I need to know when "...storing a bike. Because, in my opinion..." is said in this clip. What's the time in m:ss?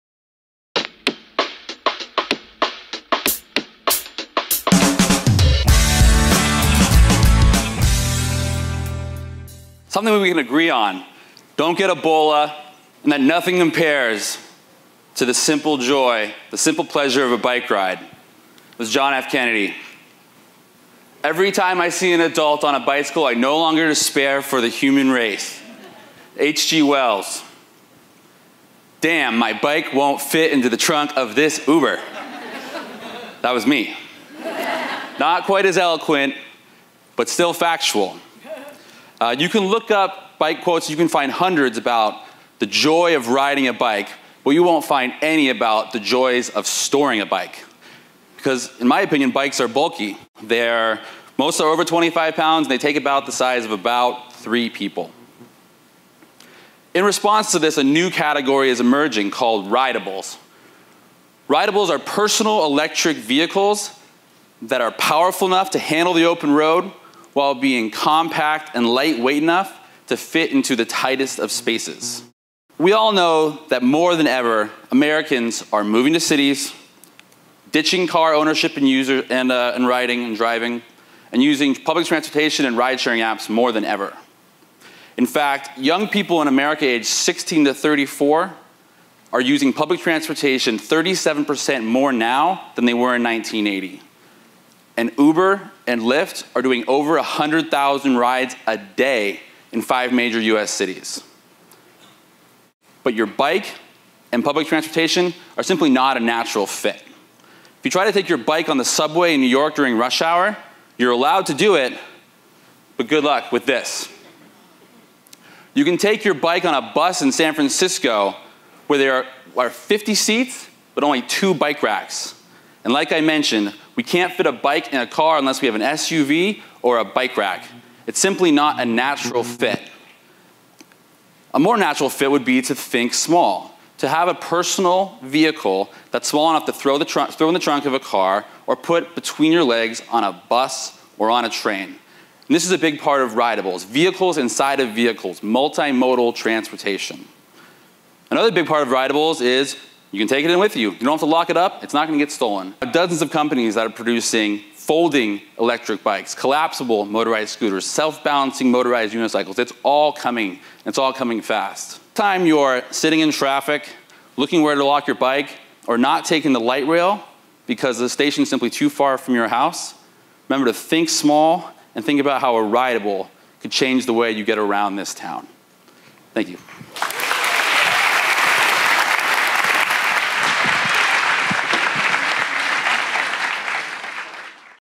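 0:46.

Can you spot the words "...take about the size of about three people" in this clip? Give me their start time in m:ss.
0:52.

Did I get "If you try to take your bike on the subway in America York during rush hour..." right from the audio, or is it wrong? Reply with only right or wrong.
wrong.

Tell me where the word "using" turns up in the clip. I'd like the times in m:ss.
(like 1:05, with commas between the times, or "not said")
1:21, 1:29.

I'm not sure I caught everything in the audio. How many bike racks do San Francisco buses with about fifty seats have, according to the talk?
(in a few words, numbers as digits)
2.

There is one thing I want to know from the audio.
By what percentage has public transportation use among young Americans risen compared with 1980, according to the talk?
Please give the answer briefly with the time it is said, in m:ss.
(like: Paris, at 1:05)
37%, at 1:30.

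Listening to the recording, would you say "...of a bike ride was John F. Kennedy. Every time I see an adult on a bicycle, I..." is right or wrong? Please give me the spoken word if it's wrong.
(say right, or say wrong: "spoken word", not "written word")
right.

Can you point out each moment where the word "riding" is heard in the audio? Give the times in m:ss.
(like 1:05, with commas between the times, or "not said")
0:43, 1:19.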